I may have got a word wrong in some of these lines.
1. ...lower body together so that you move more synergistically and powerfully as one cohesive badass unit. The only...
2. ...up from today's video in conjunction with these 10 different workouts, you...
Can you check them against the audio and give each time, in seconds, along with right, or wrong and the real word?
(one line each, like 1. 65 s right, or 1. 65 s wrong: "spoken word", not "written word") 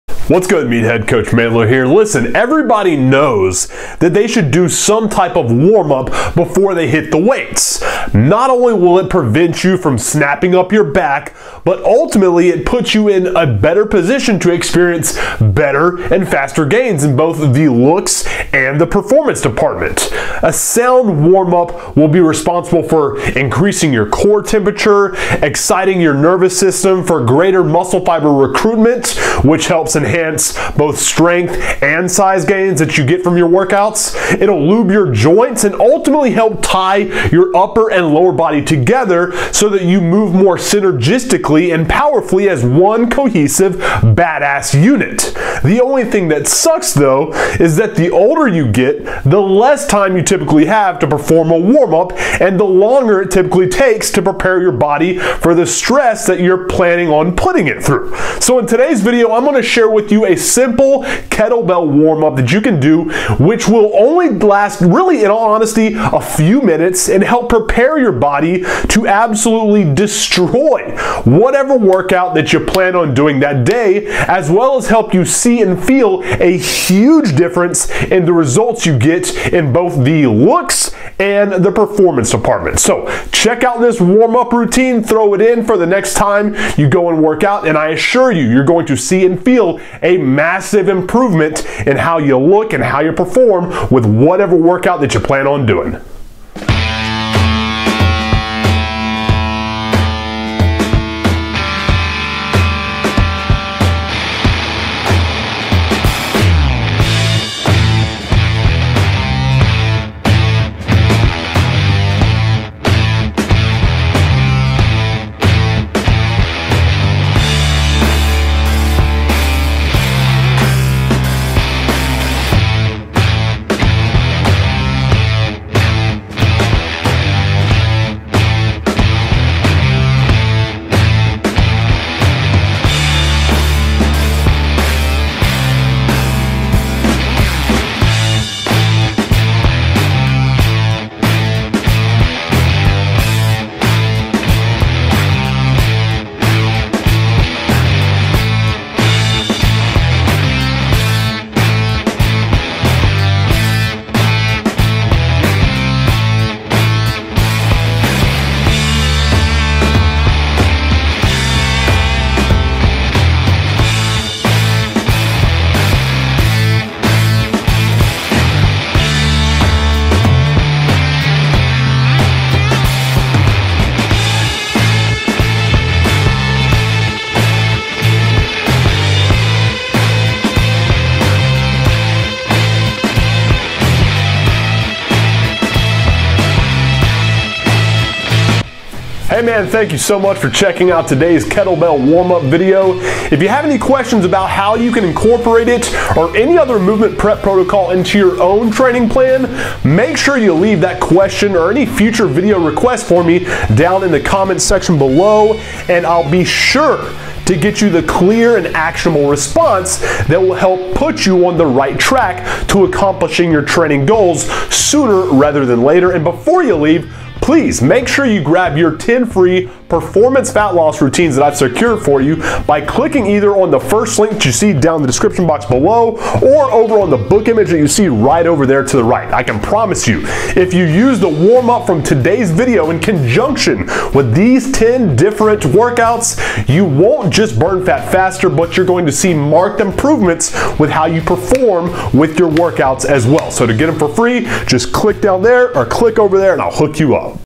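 1. 38 s right
2. 231 s right.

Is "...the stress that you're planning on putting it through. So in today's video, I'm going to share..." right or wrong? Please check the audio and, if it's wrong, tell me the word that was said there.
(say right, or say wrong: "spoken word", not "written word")
right.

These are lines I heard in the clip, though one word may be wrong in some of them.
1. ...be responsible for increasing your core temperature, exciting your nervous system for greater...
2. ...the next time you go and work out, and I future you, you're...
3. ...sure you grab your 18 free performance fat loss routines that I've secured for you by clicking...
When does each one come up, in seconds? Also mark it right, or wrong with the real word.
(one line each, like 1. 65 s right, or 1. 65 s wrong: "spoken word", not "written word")
1. 22 s right
2. 85 s wrong: "assure", not "future"
3. 218 s wrong: "10", not "18".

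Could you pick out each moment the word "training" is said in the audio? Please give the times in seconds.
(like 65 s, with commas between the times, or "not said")
198 s, 213 s.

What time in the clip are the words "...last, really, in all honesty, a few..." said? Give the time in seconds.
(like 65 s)
64 s.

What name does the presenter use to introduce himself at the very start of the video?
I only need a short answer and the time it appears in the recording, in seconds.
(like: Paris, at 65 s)
Coach Mandler, at 1 s.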